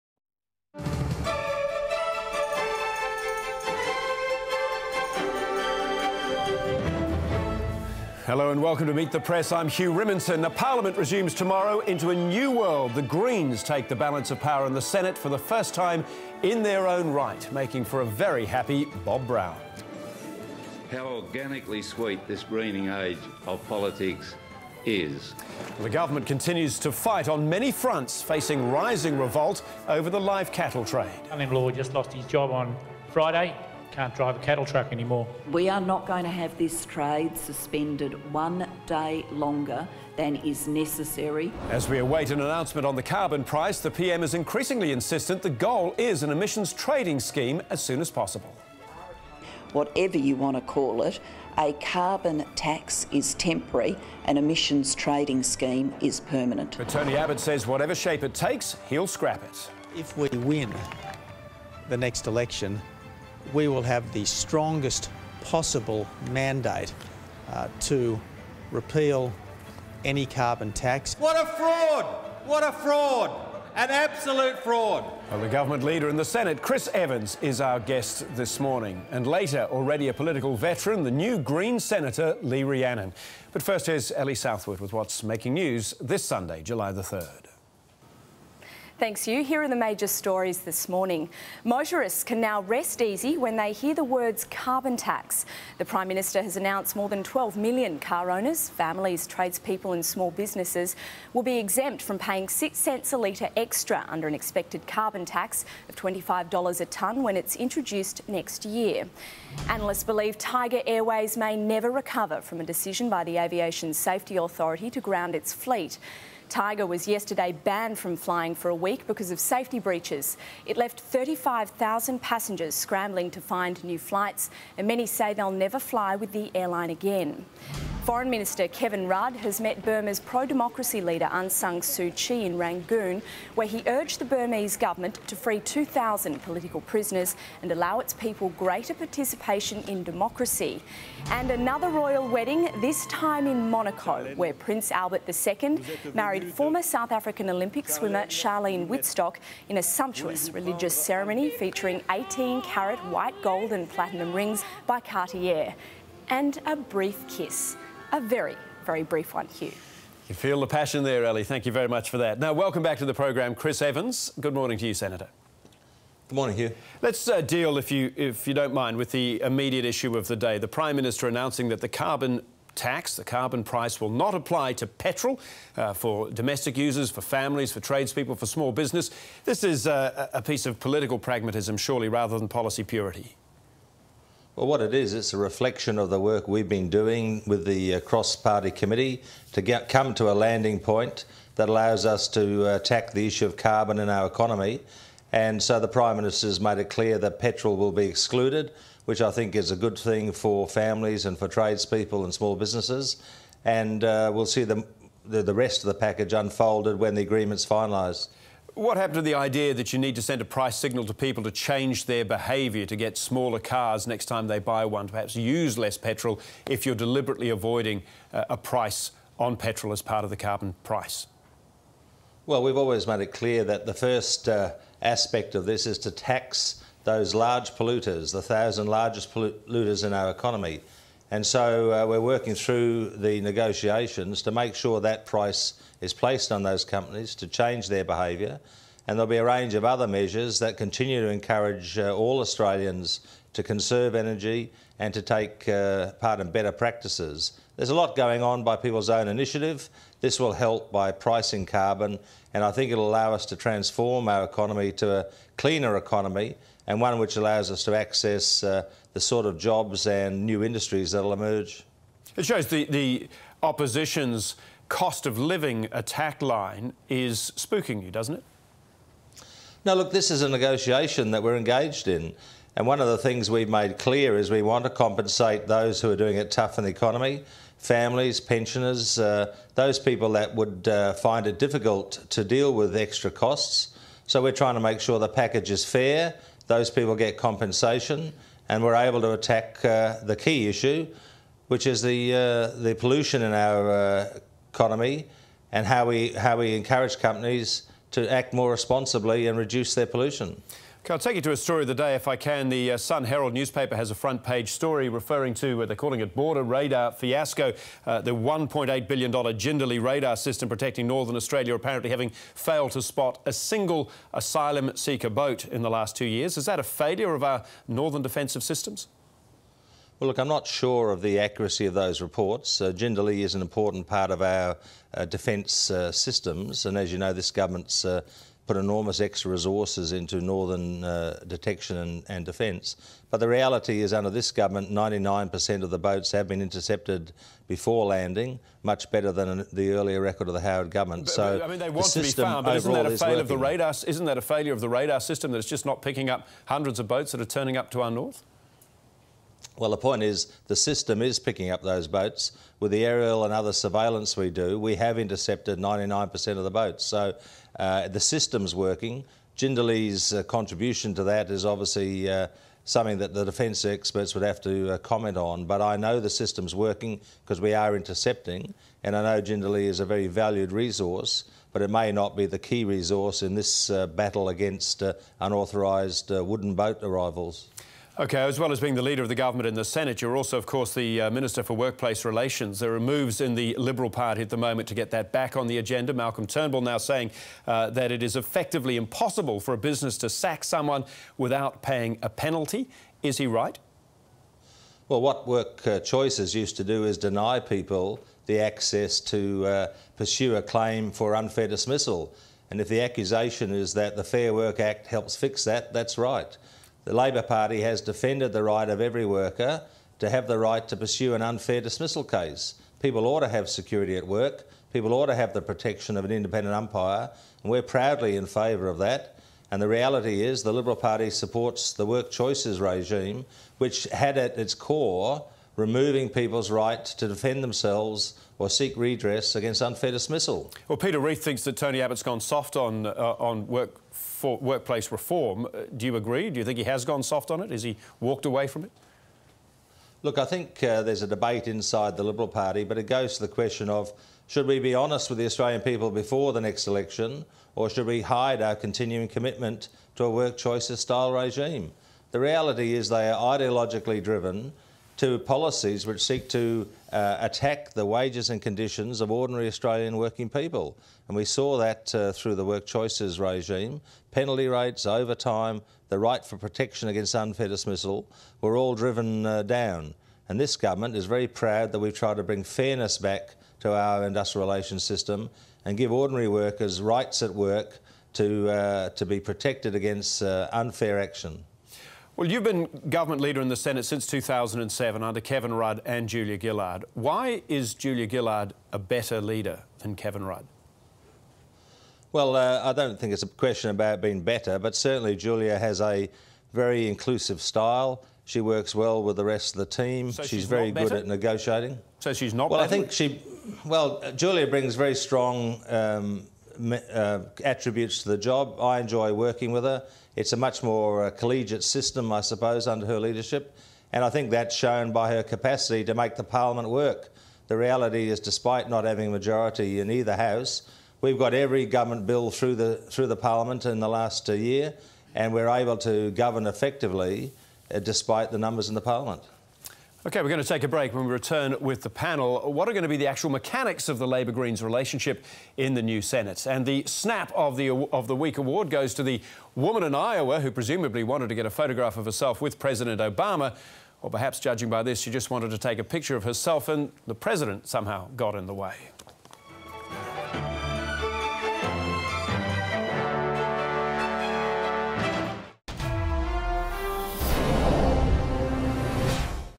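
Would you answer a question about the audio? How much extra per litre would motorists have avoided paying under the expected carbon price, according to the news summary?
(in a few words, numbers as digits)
6 cents.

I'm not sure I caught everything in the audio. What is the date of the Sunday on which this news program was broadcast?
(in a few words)
July 3.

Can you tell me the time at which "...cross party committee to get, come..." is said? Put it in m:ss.
3:08.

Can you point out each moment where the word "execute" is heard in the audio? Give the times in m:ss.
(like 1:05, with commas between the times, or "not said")
not said.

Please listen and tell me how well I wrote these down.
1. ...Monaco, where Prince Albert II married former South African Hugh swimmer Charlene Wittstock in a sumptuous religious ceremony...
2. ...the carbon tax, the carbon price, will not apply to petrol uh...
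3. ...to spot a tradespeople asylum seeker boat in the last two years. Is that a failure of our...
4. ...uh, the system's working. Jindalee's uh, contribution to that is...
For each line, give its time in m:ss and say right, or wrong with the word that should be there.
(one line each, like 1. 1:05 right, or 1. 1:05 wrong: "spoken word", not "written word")
1. 2:23 wrong: "Olympic", not "Hugh"
2. 2:51 right
3. 5:12 wrong: "single", not "tradespeople"
4. 5:57 right.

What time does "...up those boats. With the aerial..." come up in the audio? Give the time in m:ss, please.
5:51.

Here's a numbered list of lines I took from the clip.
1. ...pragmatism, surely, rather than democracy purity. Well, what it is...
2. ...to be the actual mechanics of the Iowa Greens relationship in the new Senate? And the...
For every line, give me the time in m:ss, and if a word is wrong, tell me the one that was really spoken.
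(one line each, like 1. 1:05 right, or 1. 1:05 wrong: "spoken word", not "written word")
1. 3:01 wrong: "policy", not "democracy"
2. 8:53 wrong: "Labor", not "Iowa".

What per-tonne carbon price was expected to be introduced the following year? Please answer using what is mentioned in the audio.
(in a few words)
$25.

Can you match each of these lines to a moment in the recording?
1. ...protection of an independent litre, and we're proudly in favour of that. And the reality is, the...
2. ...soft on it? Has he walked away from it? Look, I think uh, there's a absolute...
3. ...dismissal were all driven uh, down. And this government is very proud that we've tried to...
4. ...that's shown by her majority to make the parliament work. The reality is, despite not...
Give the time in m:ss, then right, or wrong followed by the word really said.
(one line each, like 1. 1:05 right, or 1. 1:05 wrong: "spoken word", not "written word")
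1. 6:55 wrong: "umpire", not "litre"
2. 7:17 wrong: "debate", not "absolute"
3. 7:47 right
4. 8:34 wrong: "capacity", not "majority".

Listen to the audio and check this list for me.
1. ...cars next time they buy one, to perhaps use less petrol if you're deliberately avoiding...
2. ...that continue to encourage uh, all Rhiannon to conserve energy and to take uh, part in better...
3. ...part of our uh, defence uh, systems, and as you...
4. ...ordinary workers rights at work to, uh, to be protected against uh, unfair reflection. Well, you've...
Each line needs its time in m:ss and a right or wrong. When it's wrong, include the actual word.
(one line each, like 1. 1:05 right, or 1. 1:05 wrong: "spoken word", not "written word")
1. 3:33 right
2. 4:00 wrong: "Australians", not "Rhiannon"
3. 5:24 right
4. 7:56 wrong: "action", not "reflection".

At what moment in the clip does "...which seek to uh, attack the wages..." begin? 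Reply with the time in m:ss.
7:36.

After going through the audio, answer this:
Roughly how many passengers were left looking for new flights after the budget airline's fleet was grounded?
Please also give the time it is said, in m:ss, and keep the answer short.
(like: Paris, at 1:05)
35,000, at 2:00.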